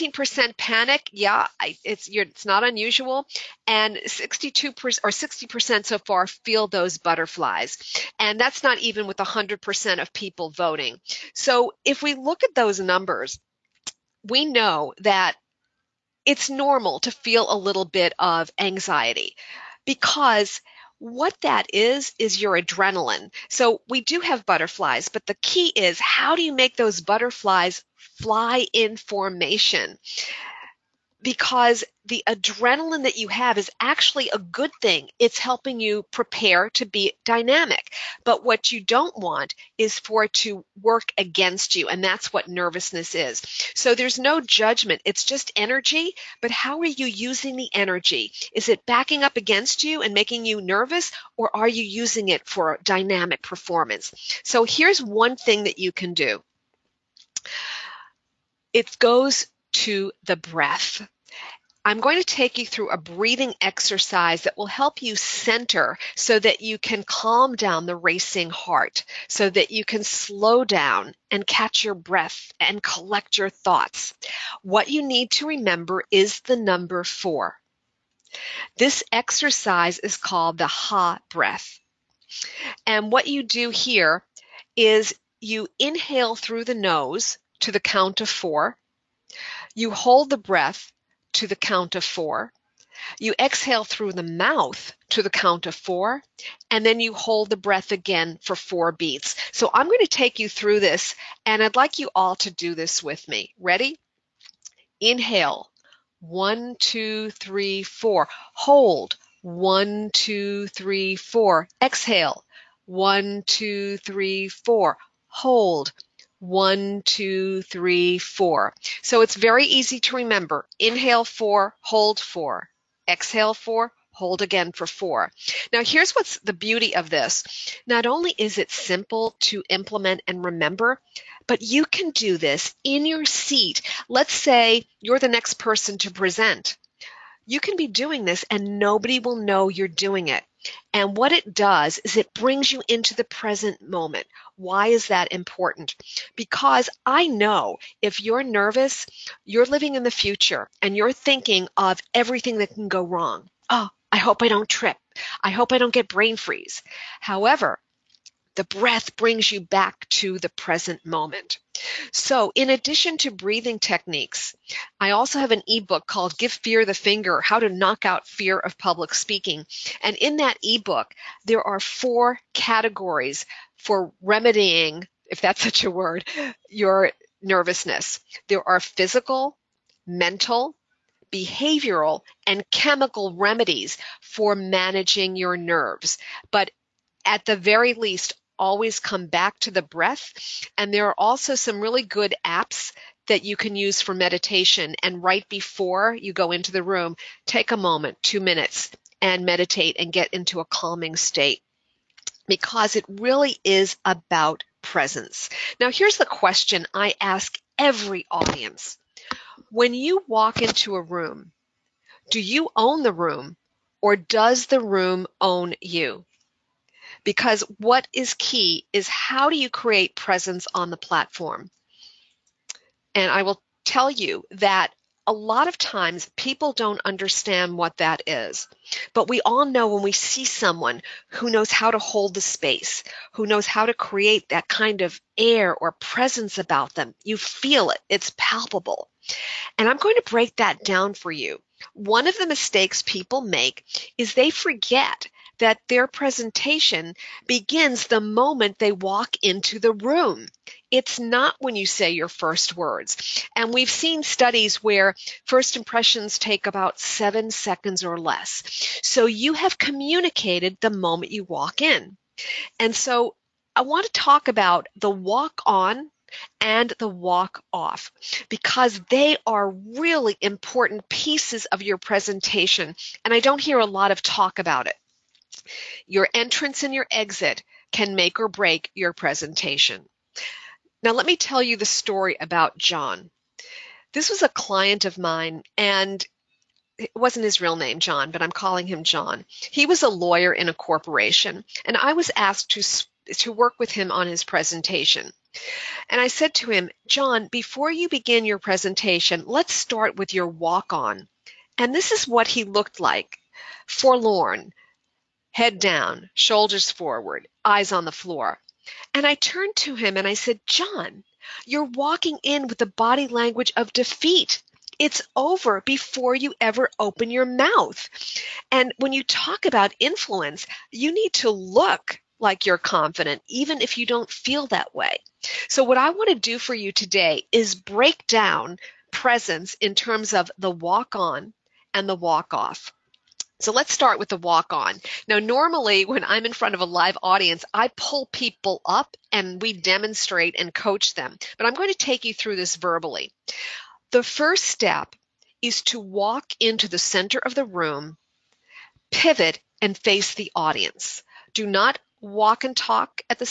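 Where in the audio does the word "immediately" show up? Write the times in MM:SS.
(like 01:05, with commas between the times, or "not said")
not said.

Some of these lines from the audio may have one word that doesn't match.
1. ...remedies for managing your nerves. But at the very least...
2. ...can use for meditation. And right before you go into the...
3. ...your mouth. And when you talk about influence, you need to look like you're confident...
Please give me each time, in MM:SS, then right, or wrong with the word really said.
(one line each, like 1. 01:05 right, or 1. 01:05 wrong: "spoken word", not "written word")
1. 03:03 right
2. 03:13 right
3. 05:17 right.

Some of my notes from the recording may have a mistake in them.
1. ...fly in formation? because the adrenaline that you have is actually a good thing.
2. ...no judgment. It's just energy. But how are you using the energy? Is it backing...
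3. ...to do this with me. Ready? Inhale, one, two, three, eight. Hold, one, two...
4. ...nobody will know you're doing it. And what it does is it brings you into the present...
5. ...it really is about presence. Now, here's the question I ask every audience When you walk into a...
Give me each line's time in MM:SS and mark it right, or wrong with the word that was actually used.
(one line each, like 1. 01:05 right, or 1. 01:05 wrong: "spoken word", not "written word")
1. 00:27 right
2. 00:44 right
3. 01:42 wrong: "four", not "eight"
4. 02:18 right
5. 03:22 right.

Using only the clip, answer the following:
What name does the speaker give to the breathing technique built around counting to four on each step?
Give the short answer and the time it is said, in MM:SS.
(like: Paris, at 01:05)
ha breath, at 01:20.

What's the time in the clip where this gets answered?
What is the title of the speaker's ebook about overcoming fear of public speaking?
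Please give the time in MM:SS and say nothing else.
02:46.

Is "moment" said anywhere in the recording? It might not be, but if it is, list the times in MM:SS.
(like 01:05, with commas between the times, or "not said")
02:23, 02:41, 03:17, 04:08, 04:20.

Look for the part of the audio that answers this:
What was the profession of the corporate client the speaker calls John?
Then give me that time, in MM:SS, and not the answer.
04:50.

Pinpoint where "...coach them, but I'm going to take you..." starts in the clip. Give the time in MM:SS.
05:40.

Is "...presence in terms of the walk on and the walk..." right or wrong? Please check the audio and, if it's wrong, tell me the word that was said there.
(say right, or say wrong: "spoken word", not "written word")
right.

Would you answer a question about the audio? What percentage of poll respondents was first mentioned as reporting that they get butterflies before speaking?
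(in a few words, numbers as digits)
62%.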